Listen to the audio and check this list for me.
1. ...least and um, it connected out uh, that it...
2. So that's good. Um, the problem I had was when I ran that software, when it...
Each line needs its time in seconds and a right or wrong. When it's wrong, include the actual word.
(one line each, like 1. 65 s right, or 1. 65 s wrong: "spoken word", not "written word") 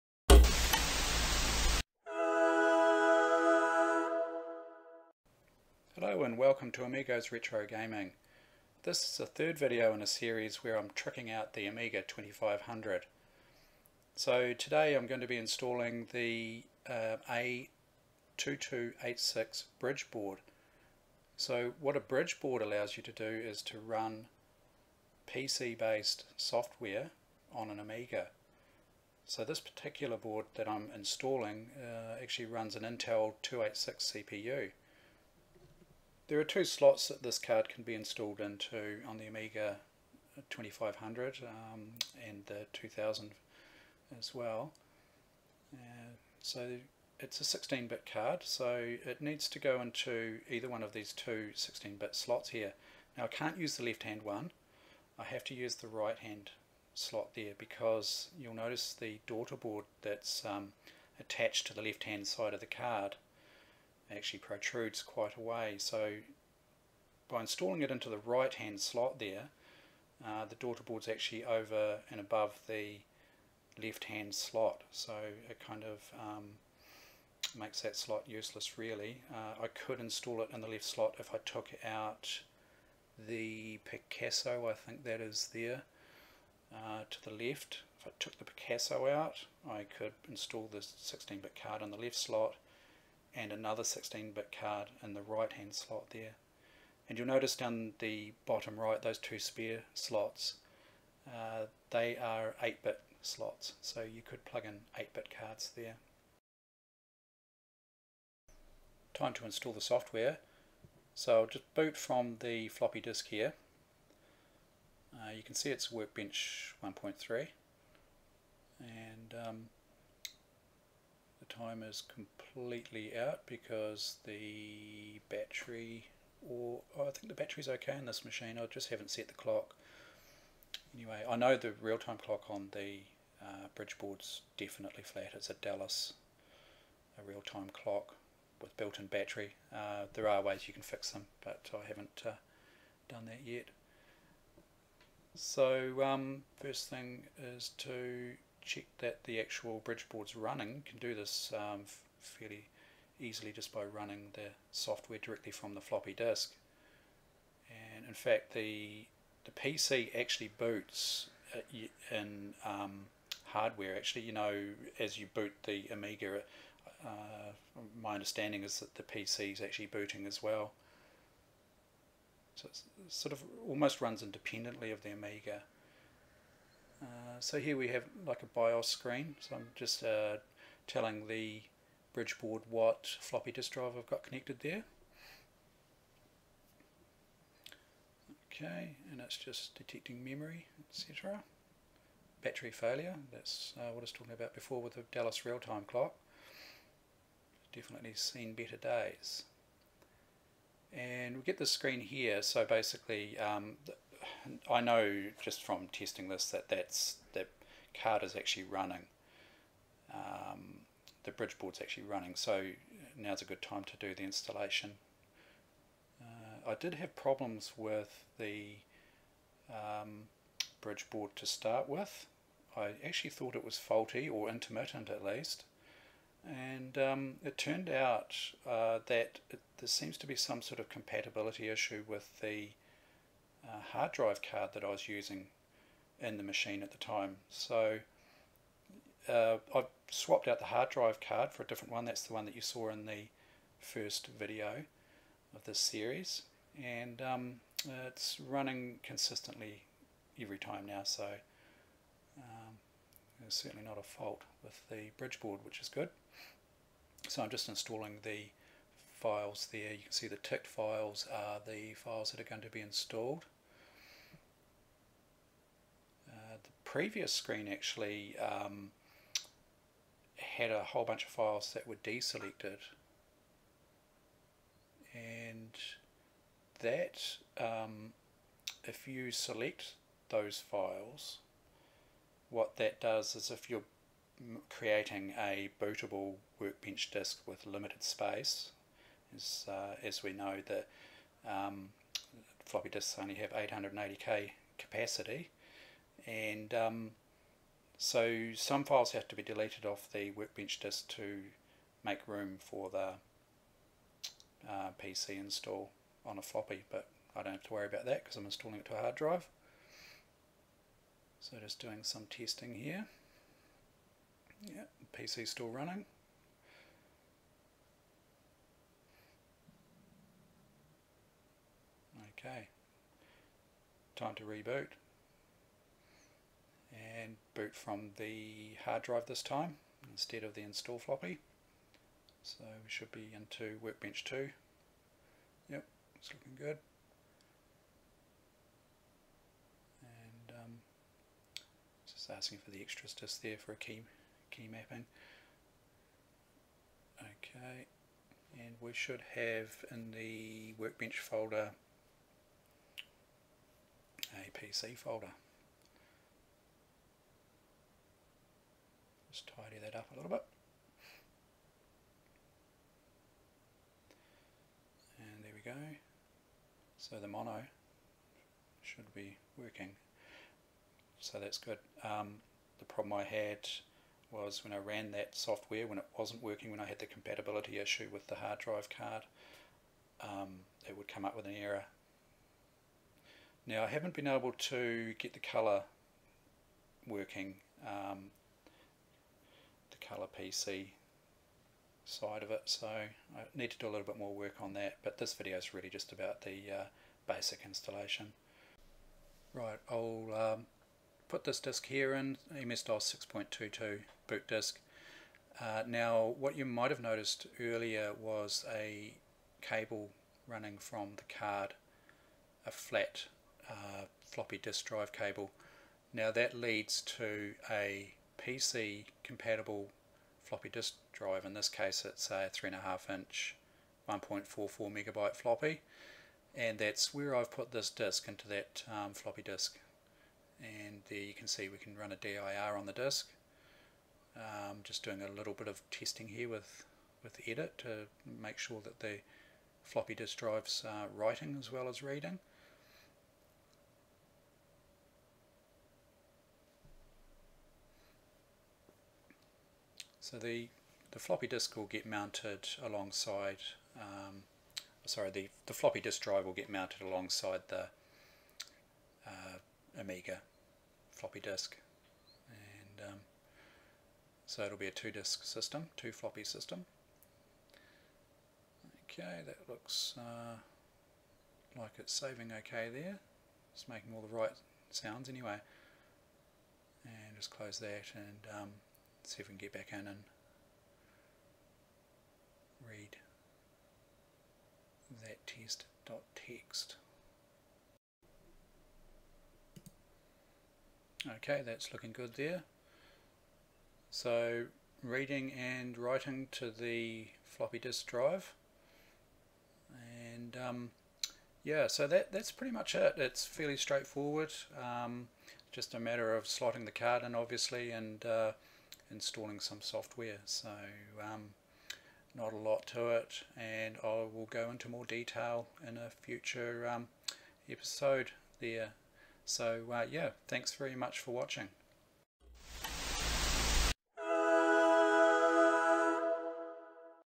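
1. 225 s wrong: "turned", not "connected"
2. 371 s right.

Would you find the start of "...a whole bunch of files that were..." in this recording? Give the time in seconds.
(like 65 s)
270 s.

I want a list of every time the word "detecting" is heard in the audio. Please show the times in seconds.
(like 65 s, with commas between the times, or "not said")
189 s.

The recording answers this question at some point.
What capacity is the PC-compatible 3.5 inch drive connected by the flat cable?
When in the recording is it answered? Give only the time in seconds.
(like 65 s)
424 s.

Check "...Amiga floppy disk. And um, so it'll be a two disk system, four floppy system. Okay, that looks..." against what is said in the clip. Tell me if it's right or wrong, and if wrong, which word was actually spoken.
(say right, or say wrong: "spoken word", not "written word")
wrong: "two", not "four".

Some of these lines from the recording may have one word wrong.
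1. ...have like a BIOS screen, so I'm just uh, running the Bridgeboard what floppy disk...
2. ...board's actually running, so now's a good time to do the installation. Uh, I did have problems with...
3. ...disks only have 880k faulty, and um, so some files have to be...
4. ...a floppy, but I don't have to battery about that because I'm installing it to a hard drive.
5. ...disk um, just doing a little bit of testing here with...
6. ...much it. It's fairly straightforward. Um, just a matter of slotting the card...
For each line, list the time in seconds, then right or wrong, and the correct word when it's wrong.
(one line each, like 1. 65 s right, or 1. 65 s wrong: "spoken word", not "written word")
1. 177 s wrong: "telling", not "running"
2. 211 s right
3. 292 s wrong: "capacity", not "faulty"
4. 306 s wrong: "worry", not "battery"
5. 432 s right
6. 502 s right.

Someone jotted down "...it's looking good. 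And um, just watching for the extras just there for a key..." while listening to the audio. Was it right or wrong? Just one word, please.
wrong.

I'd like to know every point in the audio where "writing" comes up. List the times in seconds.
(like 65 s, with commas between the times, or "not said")
441 s, 495 s.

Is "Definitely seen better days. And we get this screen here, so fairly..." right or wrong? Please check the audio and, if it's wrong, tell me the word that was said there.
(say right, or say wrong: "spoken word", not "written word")
wrong: "basically", not "fairly".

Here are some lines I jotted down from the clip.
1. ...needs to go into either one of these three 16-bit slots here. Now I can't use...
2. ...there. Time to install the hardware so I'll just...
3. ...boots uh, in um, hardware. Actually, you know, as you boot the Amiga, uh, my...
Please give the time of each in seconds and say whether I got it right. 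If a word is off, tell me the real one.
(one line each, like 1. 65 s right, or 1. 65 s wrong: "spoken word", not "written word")
1. 49 s wrong: "two", not "three"
2. 105 s wrong: "software", not "hardware"
3. 160 s right.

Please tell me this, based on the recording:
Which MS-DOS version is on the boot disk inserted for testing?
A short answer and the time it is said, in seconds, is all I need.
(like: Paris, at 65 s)
6.22, at 403 s.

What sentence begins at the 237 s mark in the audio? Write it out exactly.
So uh, I've swapped out the hard drive card for a different one.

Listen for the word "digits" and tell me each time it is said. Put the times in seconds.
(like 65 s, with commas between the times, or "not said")
not said.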